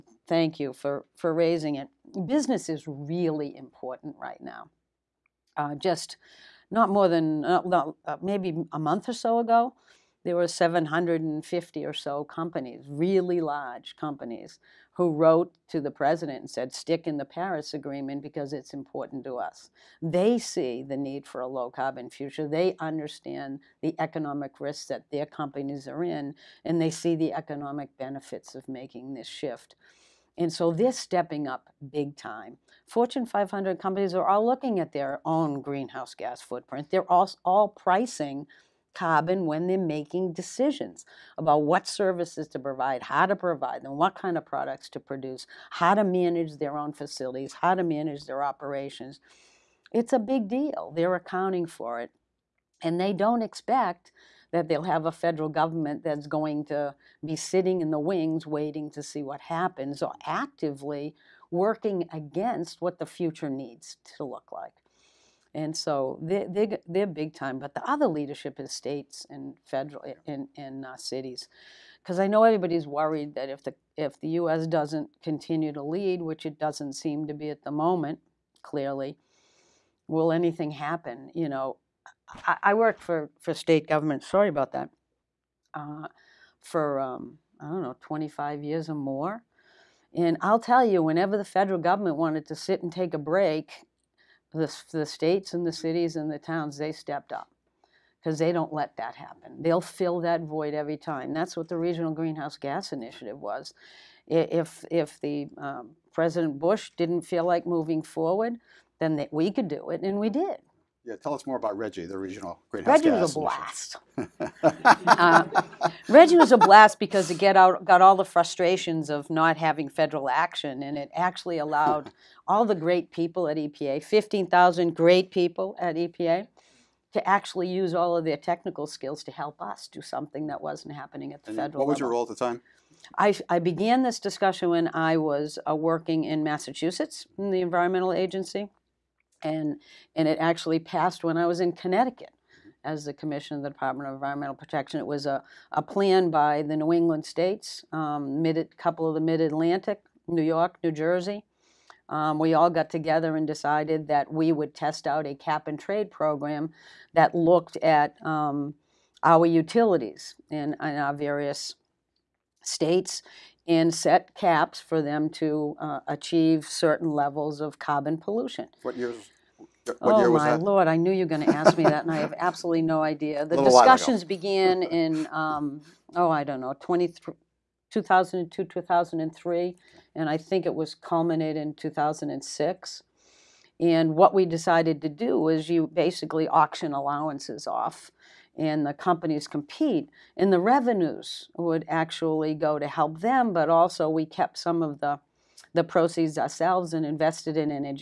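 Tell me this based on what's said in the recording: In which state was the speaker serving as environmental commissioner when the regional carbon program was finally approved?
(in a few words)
Connecticut.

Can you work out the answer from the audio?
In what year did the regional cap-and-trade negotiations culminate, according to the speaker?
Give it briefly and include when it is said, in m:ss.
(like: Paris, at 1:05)
2006, at 3:01.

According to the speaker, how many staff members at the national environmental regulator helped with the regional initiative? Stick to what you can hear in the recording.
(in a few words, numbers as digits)
15,000.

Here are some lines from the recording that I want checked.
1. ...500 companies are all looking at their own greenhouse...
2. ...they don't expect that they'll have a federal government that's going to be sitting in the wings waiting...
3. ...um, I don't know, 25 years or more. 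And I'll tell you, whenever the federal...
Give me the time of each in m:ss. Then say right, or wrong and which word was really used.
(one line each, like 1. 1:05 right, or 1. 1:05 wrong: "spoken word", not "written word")
1. 0:33 right
2. 0:52 right
3. 1:26 right.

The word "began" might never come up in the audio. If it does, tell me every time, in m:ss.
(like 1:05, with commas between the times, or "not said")
2:13, 2:54.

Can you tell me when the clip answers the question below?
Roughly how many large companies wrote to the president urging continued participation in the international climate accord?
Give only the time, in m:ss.
0:10.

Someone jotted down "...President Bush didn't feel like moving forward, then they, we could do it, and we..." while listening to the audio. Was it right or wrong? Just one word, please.
right.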